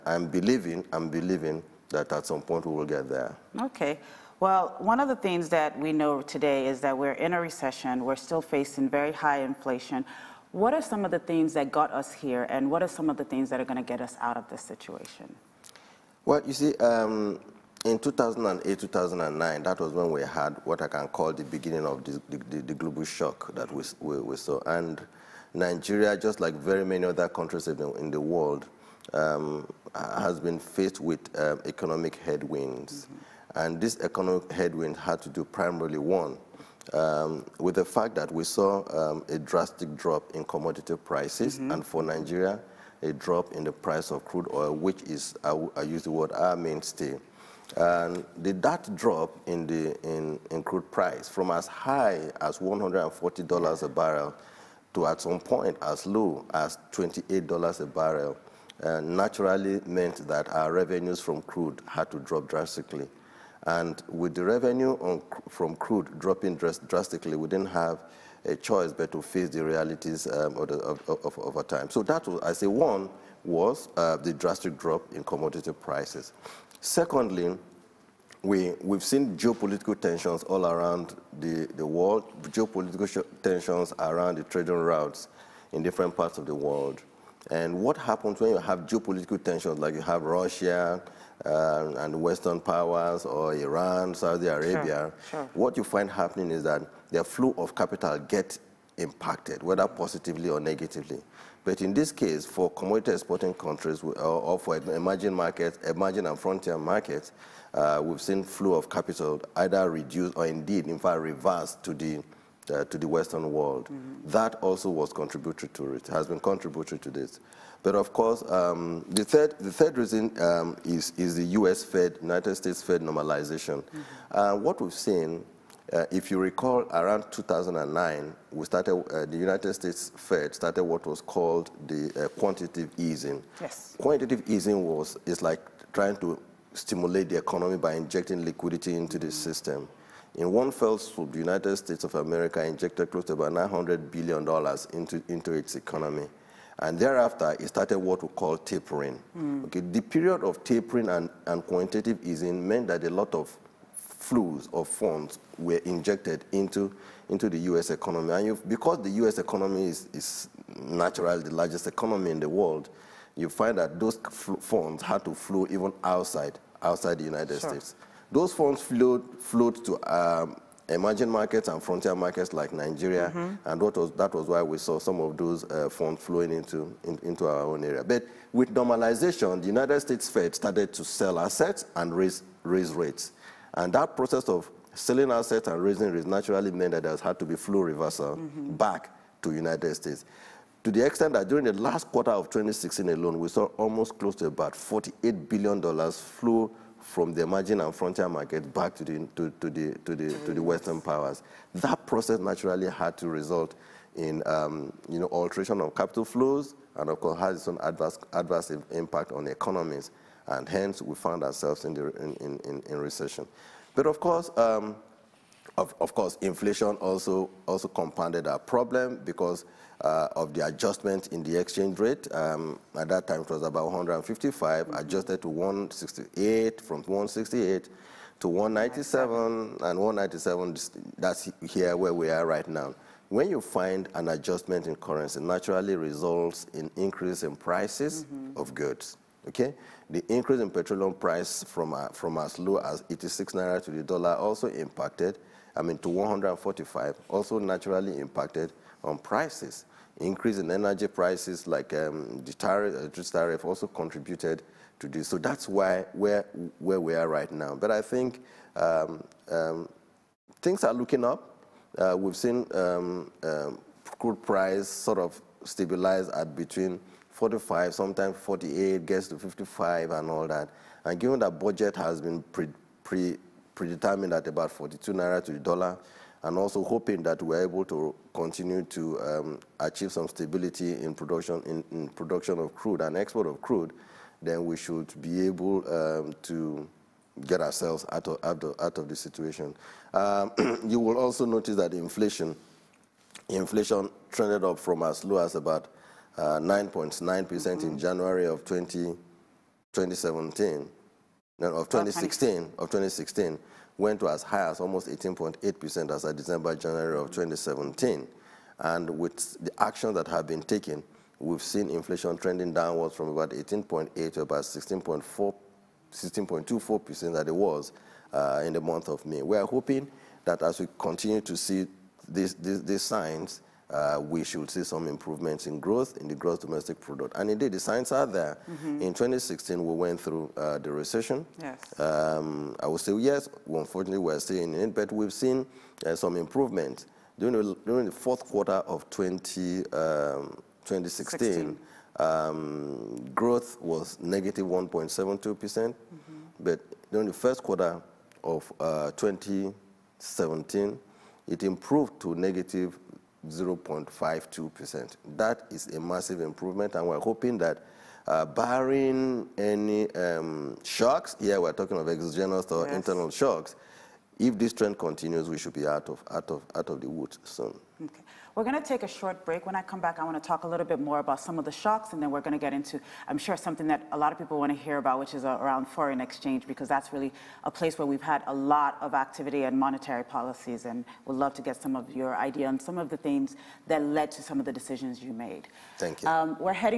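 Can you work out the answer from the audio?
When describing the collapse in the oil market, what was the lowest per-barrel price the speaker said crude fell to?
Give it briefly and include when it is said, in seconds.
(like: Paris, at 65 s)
$28, at 56 s.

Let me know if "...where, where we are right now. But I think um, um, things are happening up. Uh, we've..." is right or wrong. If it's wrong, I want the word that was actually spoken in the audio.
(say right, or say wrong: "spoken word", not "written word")
wrong: "looking", not "happening".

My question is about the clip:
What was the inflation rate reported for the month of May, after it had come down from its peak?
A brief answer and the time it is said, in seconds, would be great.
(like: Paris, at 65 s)
16.24%, at 316 s.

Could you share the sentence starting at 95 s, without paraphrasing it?
what you find happening is that their flow of capital gets impacted, whether positively or negatively.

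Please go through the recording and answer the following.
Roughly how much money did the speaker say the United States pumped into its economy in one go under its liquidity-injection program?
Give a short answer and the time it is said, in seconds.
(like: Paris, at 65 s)
$900 billion, at 143 s.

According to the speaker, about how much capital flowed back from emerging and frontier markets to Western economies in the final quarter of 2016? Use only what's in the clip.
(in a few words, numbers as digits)
$48 billion.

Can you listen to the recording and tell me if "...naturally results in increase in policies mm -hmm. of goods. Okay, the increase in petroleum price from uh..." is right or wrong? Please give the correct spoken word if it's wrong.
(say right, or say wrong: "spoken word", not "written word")
wrong: "prices", not "policies".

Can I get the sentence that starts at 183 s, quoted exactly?
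And that process of selling assets and raising rates naturally meant that there had to be flow reversal mm -hmm.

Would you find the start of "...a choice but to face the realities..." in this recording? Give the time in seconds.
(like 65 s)
68 s.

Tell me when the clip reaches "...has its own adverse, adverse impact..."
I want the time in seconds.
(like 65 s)
207 s.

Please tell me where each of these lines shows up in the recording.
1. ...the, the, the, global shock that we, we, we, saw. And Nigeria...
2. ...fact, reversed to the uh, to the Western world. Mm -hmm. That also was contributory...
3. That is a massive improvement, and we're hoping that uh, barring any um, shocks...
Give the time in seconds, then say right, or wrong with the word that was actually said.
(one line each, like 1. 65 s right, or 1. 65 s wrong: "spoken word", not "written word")
1. 22 s right
2. 110 s right
3. 355 s right.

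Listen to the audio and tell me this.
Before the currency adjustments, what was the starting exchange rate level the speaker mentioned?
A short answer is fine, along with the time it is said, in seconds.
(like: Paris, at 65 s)
155, at 223 s.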